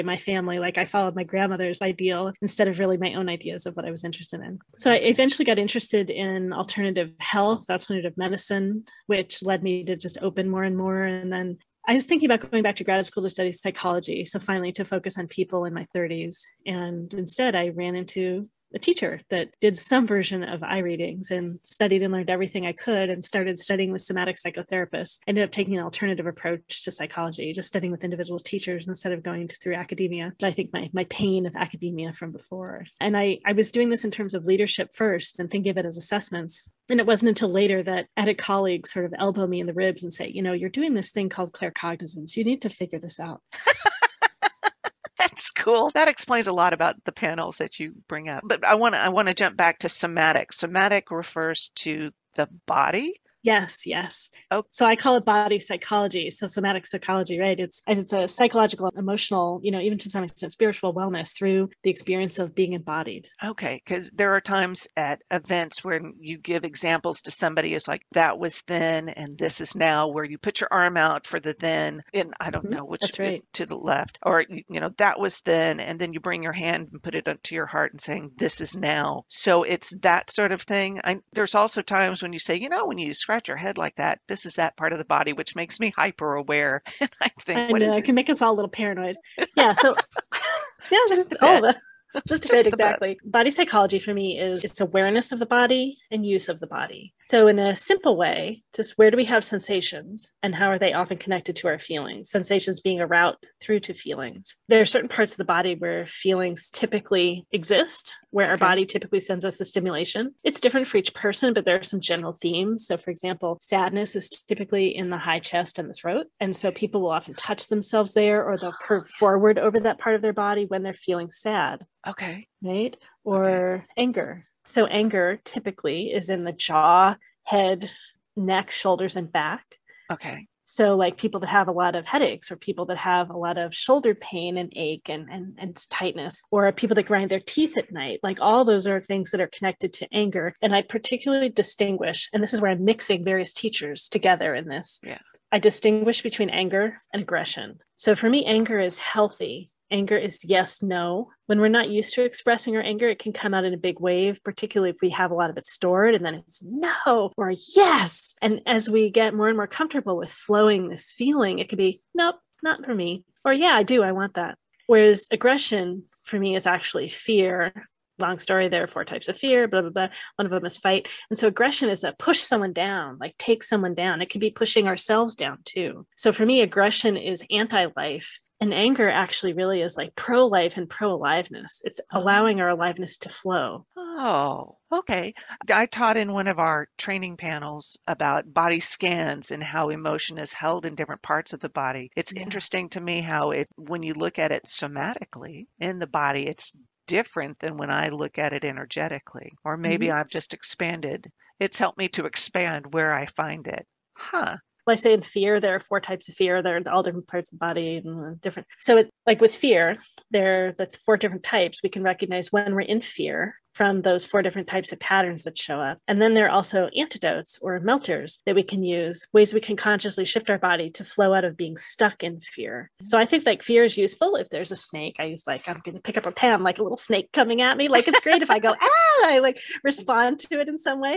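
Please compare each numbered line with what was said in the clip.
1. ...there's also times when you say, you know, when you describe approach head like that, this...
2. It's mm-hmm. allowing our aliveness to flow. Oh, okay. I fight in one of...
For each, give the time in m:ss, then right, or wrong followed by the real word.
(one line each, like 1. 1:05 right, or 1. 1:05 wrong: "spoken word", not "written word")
1. 1:21 wrong: "scratch", not "approach"
2. 3:01 wrong: "taught", not "fight".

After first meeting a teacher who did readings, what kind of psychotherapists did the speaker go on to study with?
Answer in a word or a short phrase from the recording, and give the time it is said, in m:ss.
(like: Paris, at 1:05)
Somatic psychotherapists, at 0:24.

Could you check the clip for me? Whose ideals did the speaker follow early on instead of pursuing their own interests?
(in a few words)
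Grandmother's.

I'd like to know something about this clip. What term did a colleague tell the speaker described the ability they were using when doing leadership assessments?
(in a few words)
Claircognizance.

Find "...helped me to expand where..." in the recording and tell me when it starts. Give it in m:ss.
3:21.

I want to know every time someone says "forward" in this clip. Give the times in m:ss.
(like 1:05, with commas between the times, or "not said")
1:59.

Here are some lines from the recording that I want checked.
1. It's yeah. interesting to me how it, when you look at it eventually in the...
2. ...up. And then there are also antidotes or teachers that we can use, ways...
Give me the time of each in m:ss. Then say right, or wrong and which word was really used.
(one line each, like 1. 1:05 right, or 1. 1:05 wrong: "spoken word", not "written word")
1. 3:12 wrong: "somatically", not "eventually"
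2. 3:35 wrong: "melters", not "teachers".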